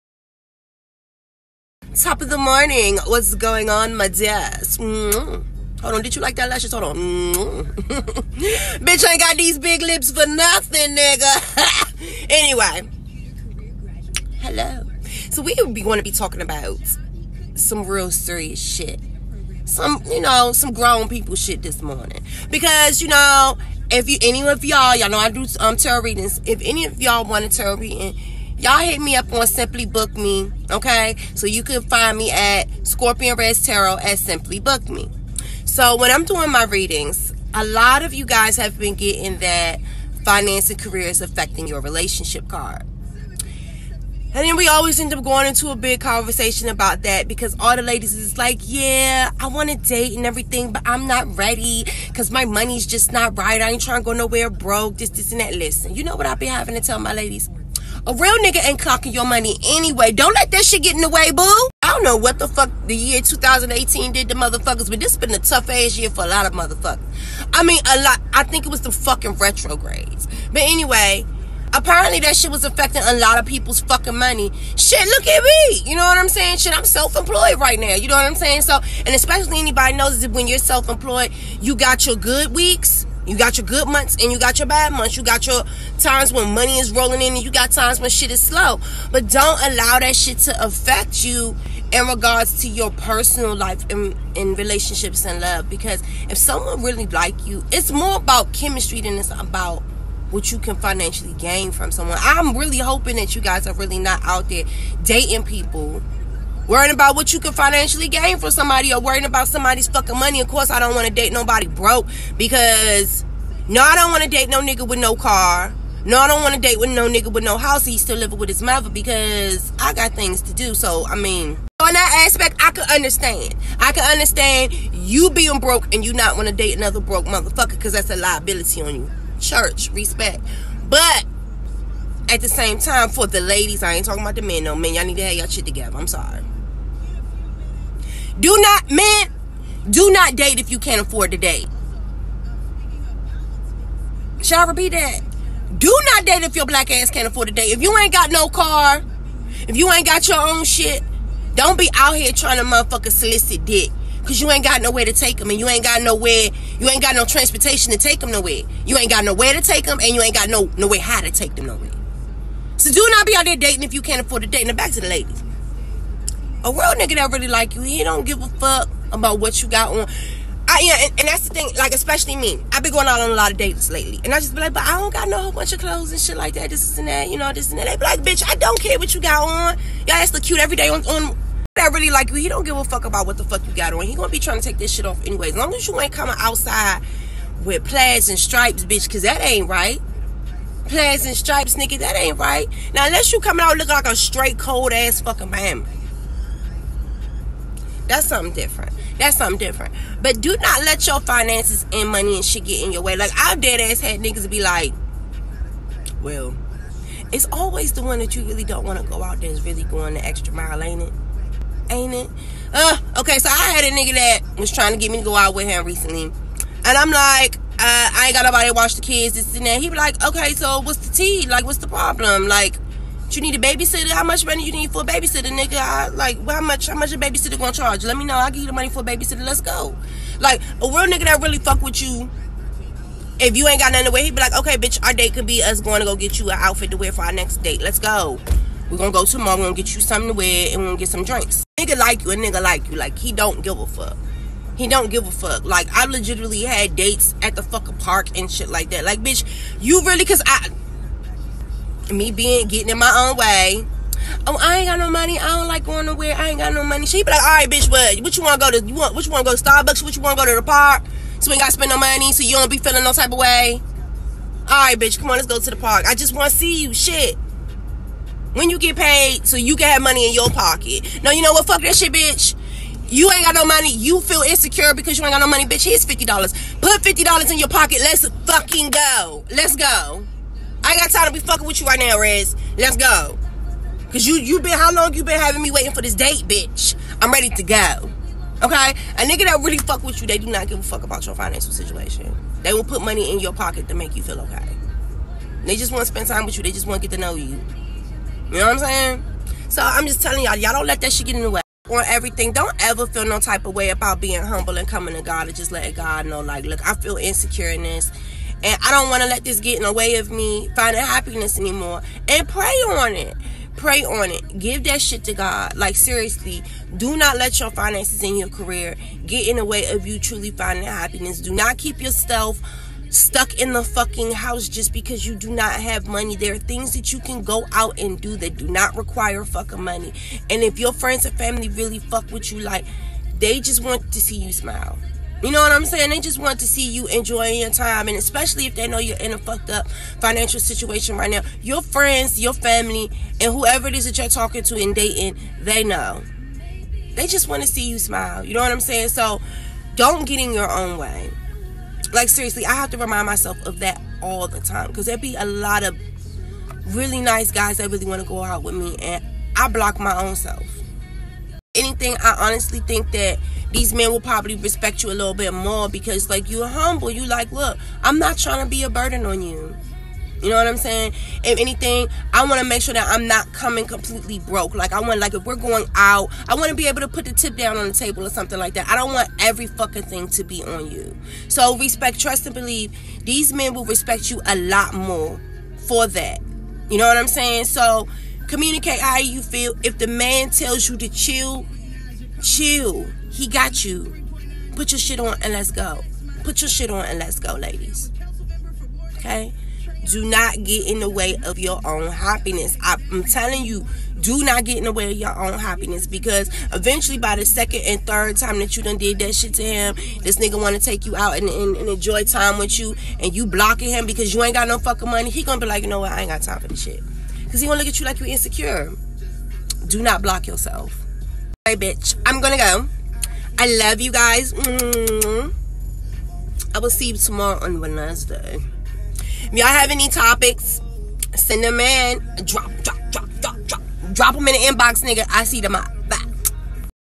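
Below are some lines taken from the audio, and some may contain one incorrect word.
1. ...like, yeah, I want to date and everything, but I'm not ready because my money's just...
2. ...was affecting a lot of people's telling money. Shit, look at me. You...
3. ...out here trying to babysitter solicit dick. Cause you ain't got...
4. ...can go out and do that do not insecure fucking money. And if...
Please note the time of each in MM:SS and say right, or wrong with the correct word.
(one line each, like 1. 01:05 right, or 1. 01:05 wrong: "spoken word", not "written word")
1. 00:48 right
2. 01:12 wrong: "fucking", not "telling"
3. 02:31 wrong: "motherfucker", not "babysitter"
4. 05:27 wrong: "require", not "insecure".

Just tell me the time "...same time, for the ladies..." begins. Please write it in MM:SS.
02:12.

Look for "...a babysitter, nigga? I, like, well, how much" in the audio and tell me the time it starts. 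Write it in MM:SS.
03:45.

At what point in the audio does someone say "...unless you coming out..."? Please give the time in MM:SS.
03:13.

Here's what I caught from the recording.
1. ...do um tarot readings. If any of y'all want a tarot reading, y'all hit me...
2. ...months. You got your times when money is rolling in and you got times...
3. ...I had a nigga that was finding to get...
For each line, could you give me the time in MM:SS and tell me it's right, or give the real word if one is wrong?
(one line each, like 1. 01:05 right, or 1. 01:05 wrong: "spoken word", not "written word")
1. 00:25 right
2. 01:24 right
3. 03:33 wrong: "trying", not "finding".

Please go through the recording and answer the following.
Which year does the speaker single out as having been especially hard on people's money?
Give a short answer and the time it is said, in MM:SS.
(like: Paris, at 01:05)
2018, at 01:03.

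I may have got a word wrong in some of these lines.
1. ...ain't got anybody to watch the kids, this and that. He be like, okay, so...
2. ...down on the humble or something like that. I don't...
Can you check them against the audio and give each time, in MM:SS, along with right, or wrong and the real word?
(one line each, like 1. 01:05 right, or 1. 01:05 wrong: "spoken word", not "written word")
1. 03:38 wrong: "nobody", not "anybody"
2. 06:17 wrong: "table", not "humble".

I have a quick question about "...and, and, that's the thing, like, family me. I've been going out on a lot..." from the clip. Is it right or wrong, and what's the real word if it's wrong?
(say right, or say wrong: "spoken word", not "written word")
wrong: "especially", not "family".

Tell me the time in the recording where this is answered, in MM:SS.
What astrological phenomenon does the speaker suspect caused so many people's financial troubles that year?
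01:09.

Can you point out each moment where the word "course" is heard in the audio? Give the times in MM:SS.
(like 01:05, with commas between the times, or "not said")
01:50.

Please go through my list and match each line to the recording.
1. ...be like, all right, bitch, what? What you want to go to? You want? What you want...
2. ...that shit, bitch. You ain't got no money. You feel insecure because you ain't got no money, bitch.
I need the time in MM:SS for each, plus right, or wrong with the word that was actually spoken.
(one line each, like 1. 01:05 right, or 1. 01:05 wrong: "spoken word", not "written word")
1. 04:17 right
2. 04:31 right.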